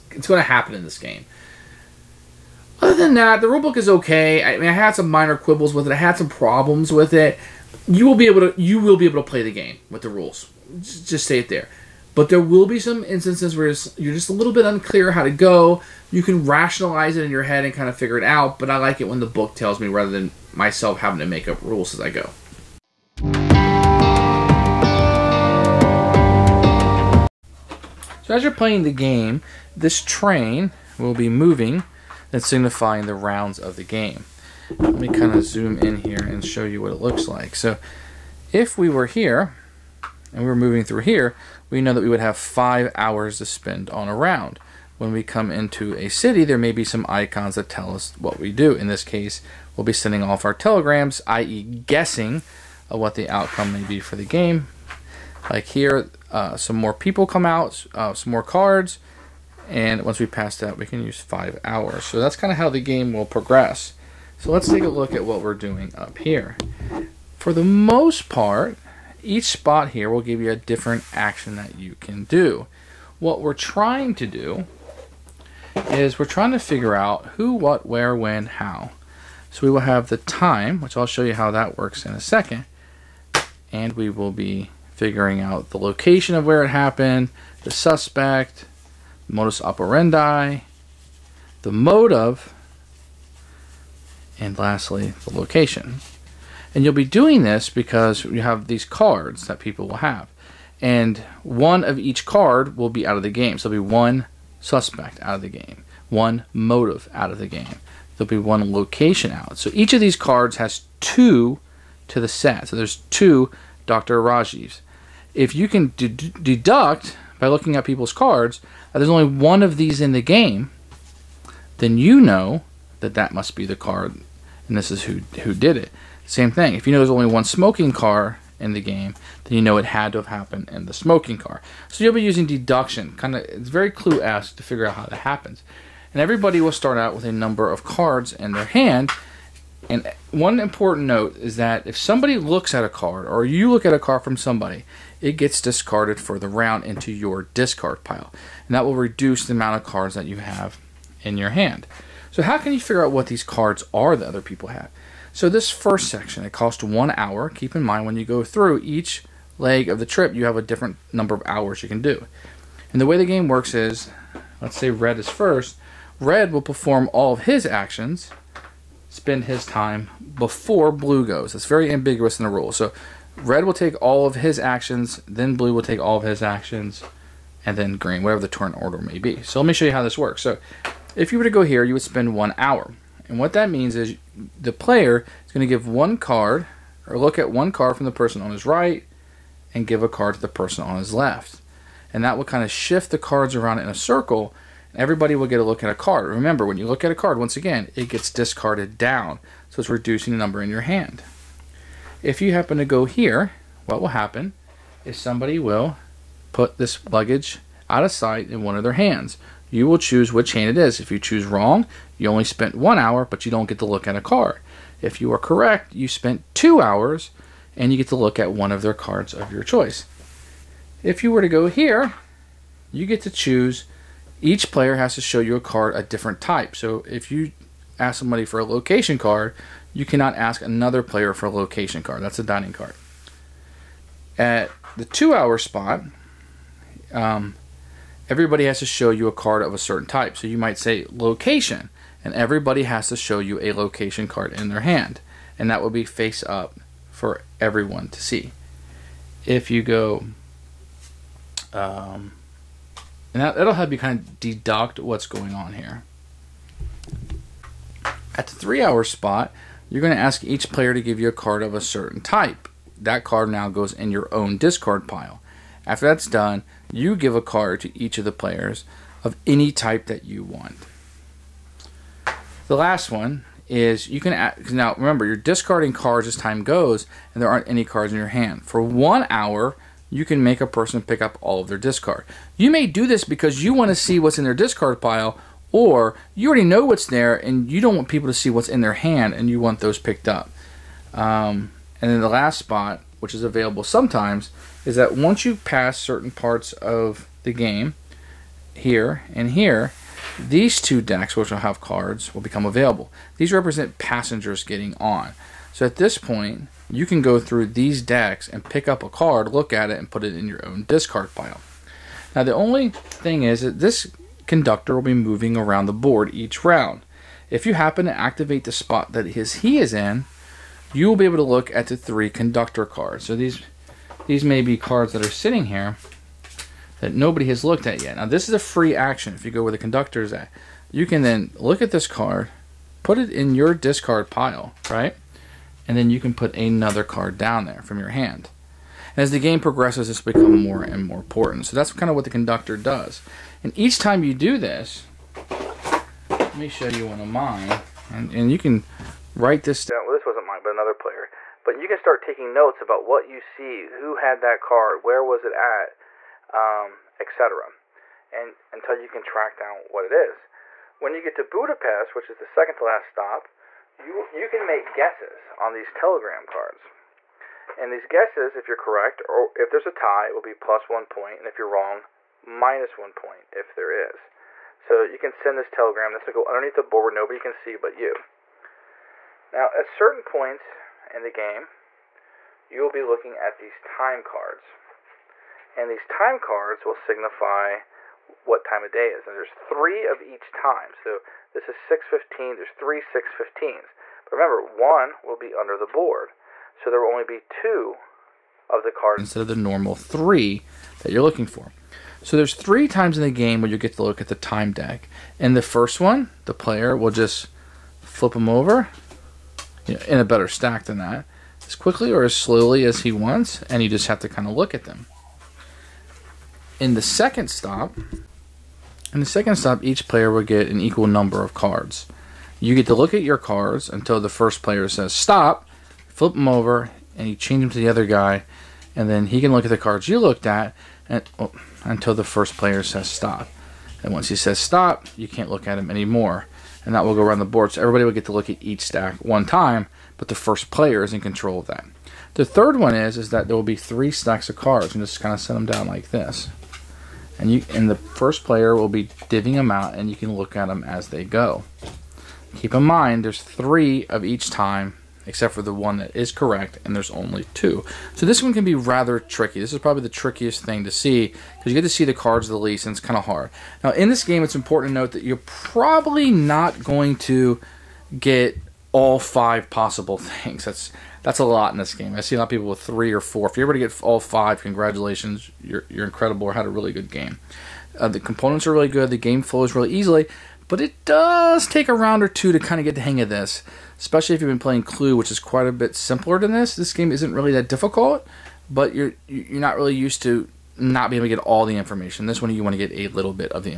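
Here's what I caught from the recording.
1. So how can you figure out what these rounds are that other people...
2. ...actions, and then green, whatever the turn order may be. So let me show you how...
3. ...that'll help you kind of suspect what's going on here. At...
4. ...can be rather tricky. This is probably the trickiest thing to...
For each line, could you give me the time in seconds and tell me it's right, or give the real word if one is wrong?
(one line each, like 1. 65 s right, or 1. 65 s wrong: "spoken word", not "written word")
1. 152 s wrong: "cards", not "rounds"
2. 176 s right
3. 253 s wrong: "deduct", not "suspect"
4. 458 s right.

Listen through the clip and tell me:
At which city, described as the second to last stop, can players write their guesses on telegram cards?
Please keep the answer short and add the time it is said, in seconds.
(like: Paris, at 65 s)
Budapest, at 361 s.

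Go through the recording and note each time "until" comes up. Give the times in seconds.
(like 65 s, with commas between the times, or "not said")
358 s, 423 s, 431 s.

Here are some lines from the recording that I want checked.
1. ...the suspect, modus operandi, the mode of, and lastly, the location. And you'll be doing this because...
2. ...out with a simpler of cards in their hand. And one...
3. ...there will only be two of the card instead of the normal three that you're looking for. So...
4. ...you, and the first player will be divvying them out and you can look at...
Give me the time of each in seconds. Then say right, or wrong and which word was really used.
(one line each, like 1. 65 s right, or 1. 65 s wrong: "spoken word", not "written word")
1. 87 s right
2. 136 s wrong: "number", not "simpler"
3. 396 s right
4. 447 s right.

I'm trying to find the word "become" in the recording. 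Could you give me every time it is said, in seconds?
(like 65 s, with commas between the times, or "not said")
302 s, 340 s.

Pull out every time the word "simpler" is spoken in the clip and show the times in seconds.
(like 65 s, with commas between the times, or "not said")
485 s.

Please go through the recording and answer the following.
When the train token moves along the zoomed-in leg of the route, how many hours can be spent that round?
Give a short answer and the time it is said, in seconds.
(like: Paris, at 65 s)
5, at 42 s.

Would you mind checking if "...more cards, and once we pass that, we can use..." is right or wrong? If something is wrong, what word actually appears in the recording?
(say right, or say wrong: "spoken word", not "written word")
right.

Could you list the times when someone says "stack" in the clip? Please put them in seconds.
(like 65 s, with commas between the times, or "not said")
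410 s, 438 s, 444 s.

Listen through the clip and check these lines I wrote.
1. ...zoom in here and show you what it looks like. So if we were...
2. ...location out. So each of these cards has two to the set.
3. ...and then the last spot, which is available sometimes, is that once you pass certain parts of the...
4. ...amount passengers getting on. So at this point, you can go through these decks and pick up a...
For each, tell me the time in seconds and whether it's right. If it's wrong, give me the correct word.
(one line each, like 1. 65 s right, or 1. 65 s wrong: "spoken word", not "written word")
1. 35 s right
2. 108 s right
3. 292 s right
4. 303 s wrong: "represent", not "amount".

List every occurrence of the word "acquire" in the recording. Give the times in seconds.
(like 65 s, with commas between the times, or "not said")
not said.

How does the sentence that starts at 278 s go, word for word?
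For one hour, you can make a person pick up all of their discard.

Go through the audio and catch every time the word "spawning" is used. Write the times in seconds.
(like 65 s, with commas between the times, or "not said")
not said.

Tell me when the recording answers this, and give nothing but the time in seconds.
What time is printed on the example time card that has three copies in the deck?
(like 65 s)
391 s.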